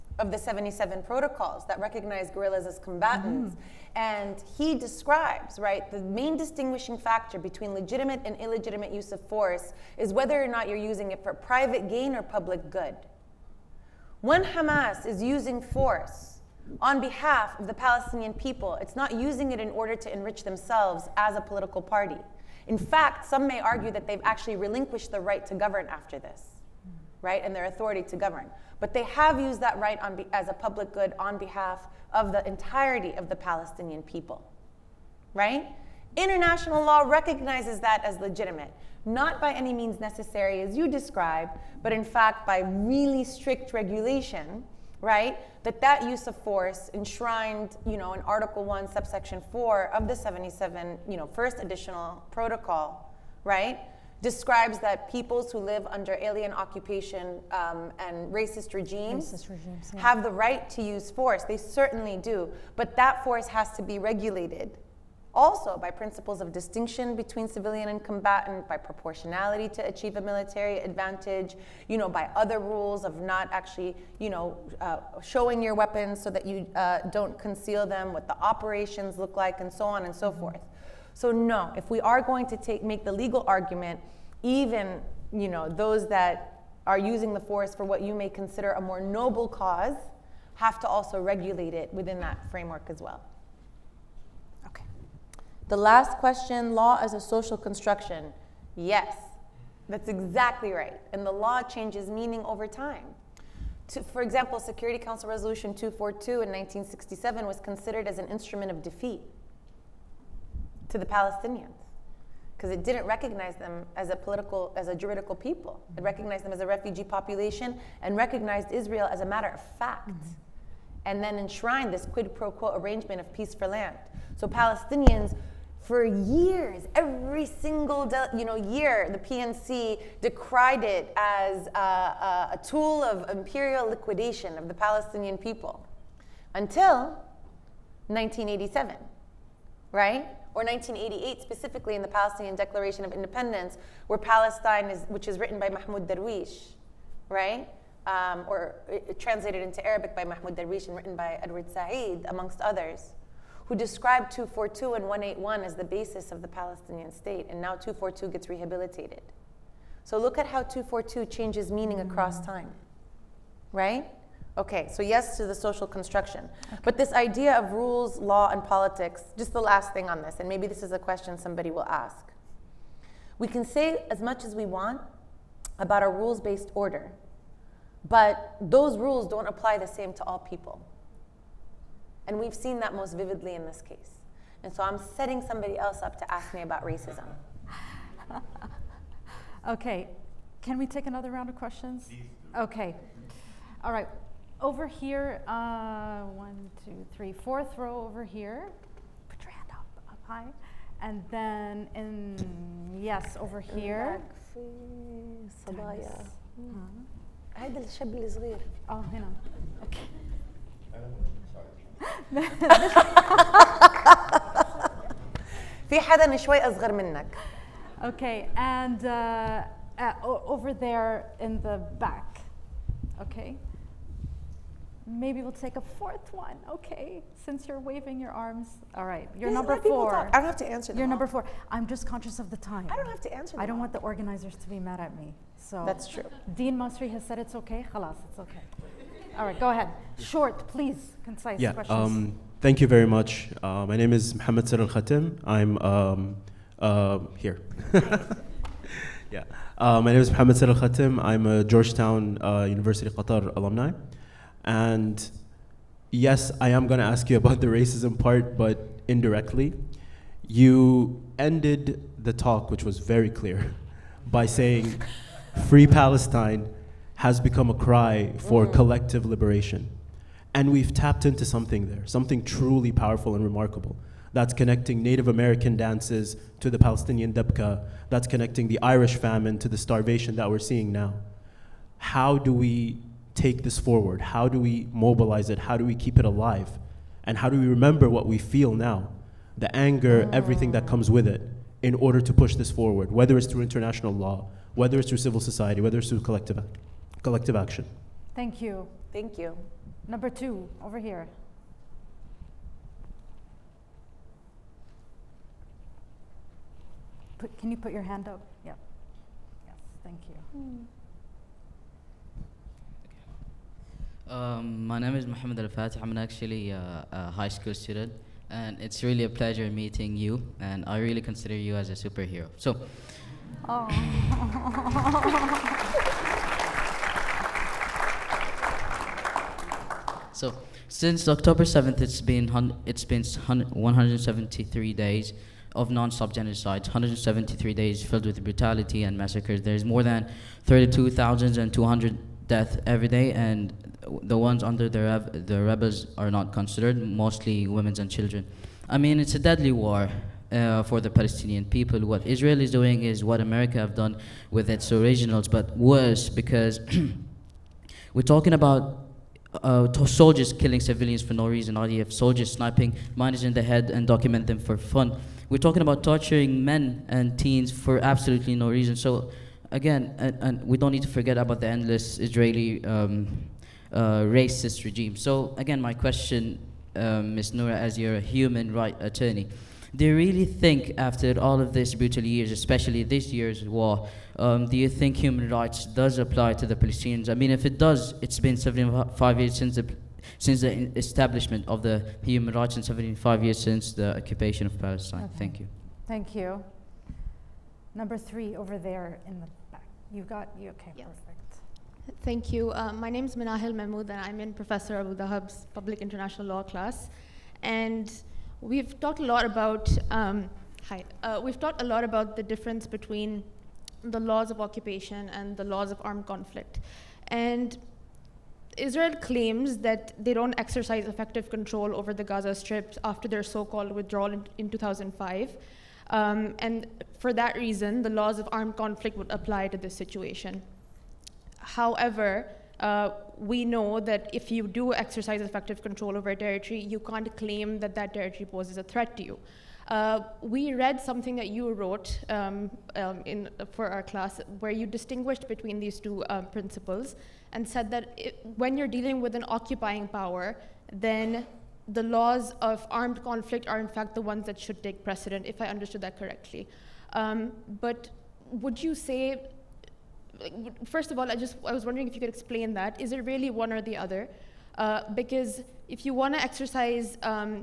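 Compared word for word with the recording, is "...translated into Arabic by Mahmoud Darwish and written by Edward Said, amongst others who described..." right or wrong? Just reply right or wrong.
right.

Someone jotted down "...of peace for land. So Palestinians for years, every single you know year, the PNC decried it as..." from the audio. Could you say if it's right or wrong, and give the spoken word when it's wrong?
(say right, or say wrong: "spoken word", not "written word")
right.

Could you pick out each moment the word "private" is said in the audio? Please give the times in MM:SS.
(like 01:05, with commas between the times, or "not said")
00:11.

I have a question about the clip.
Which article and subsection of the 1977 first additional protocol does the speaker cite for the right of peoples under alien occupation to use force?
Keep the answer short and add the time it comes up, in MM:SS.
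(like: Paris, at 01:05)
Article 1, subsection 4, at 00:48.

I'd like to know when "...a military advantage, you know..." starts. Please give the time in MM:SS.
01:10.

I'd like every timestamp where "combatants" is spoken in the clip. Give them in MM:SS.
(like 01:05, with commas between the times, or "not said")
00:02, 01:08.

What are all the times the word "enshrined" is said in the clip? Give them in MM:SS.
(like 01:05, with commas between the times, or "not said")
00:46, 02:01.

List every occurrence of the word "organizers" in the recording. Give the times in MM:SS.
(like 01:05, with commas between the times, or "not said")
03:54.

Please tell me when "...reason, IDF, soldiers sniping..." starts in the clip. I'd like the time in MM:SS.
06:01.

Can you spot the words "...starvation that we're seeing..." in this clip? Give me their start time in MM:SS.
04:39.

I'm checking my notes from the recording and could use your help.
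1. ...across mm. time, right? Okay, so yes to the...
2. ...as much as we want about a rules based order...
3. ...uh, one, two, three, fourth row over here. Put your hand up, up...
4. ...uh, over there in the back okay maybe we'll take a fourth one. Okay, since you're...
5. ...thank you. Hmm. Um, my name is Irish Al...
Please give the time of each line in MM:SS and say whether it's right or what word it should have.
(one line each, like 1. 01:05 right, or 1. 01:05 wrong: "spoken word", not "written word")
1. 02:41 right
2. 02:54 right
3. 03:15 right
4. 03:39 right
5. 05:10 wrong: "Mohammed", not "Irish".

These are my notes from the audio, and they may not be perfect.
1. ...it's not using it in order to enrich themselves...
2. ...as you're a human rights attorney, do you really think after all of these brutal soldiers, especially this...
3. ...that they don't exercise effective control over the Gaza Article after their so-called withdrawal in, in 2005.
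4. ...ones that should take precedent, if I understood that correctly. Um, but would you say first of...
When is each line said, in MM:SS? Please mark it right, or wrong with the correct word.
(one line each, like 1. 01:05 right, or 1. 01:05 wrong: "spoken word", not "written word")
1. 00:18 right
2. 06:17 wrong: "years", not "soldiers"
3. 06:59 wrong: "Strip", not "Article"
4. 07:34 right.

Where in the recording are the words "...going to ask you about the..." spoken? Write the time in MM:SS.
04:16.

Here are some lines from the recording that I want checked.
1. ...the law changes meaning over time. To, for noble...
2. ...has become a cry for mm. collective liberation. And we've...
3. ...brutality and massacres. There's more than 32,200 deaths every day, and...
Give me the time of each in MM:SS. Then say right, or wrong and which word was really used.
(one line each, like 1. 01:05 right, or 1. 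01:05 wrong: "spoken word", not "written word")
1. 01:41 wrong: "example", not "noble"
2. 04:27 right
3. 05:38 right.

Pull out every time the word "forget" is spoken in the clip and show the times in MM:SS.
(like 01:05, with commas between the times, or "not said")
06:11.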